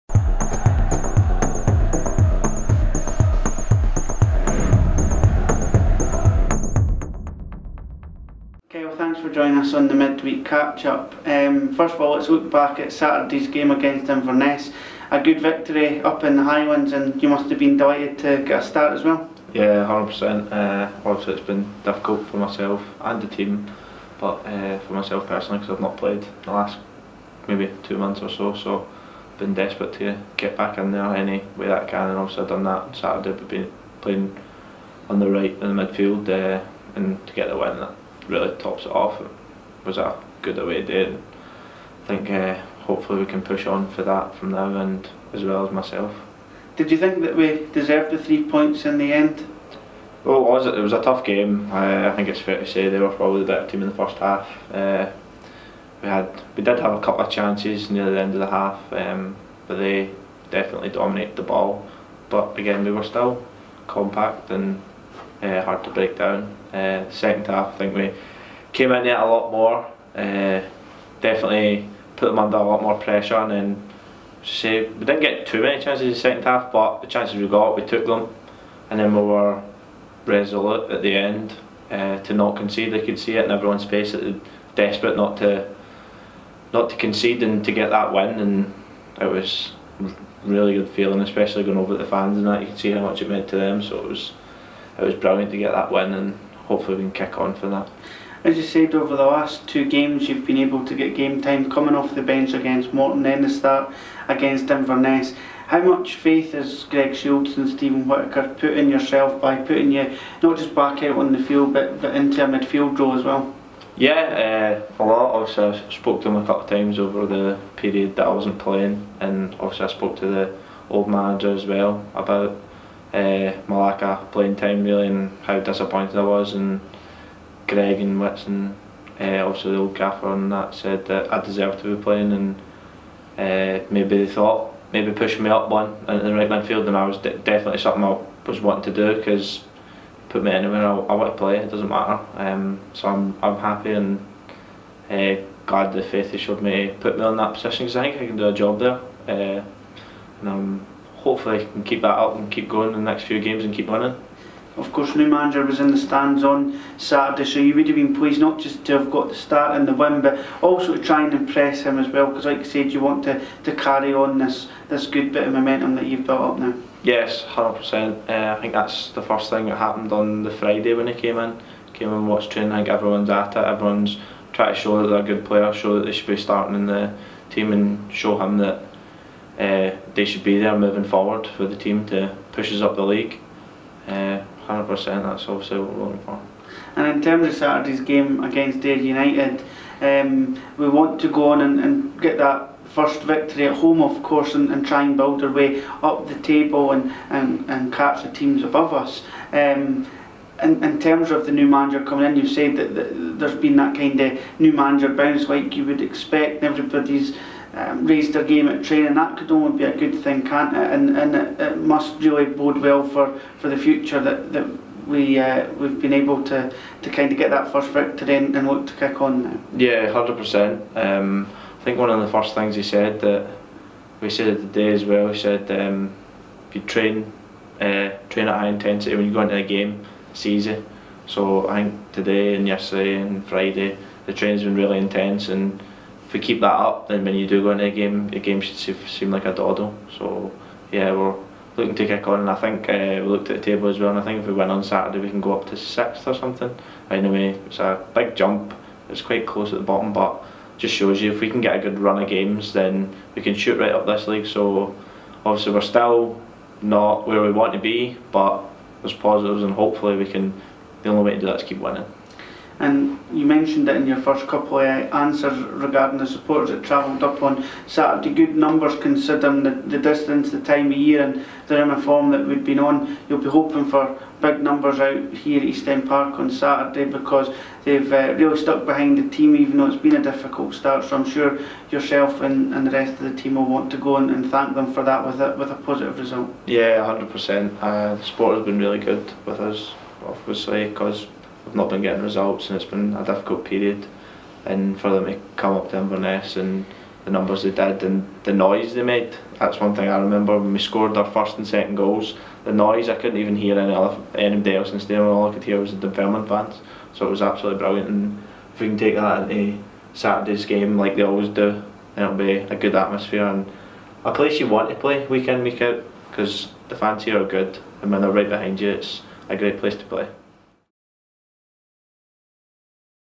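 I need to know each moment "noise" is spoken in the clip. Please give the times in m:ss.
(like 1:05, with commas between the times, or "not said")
4:58, 5:02.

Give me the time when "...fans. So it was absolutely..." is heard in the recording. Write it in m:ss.
5:06.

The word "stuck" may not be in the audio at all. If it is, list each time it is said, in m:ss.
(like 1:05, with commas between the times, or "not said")
4:38.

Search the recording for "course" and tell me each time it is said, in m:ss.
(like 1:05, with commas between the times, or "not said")
2:34, 3:14.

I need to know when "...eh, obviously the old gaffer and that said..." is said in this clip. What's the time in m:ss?
2:09.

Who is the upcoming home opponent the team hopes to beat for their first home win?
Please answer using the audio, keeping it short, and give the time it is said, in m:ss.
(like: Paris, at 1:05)
Ayr United, at 3:08.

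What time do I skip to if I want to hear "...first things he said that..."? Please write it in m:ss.
3:42.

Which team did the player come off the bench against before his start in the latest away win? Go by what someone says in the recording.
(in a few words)
Morton.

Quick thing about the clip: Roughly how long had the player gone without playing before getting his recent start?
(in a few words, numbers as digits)
2 months.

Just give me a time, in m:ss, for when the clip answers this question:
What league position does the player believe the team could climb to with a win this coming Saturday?
4:05.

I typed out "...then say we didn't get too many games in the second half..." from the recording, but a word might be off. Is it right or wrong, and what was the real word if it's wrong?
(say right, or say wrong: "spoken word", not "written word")
wrong: "chances", not "games".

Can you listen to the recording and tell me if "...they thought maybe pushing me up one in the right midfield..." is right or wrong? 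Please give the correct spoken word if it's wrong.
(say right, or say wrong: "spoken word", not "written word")
right.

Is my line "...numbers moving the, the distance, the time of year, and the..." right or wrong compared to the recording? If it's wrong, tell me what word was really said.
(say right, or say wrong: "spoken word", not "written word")
wrong: "considering", not "moving".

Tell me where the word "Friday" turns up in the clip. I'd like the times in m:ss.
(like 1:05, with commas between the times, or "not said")
2:50, 3:53.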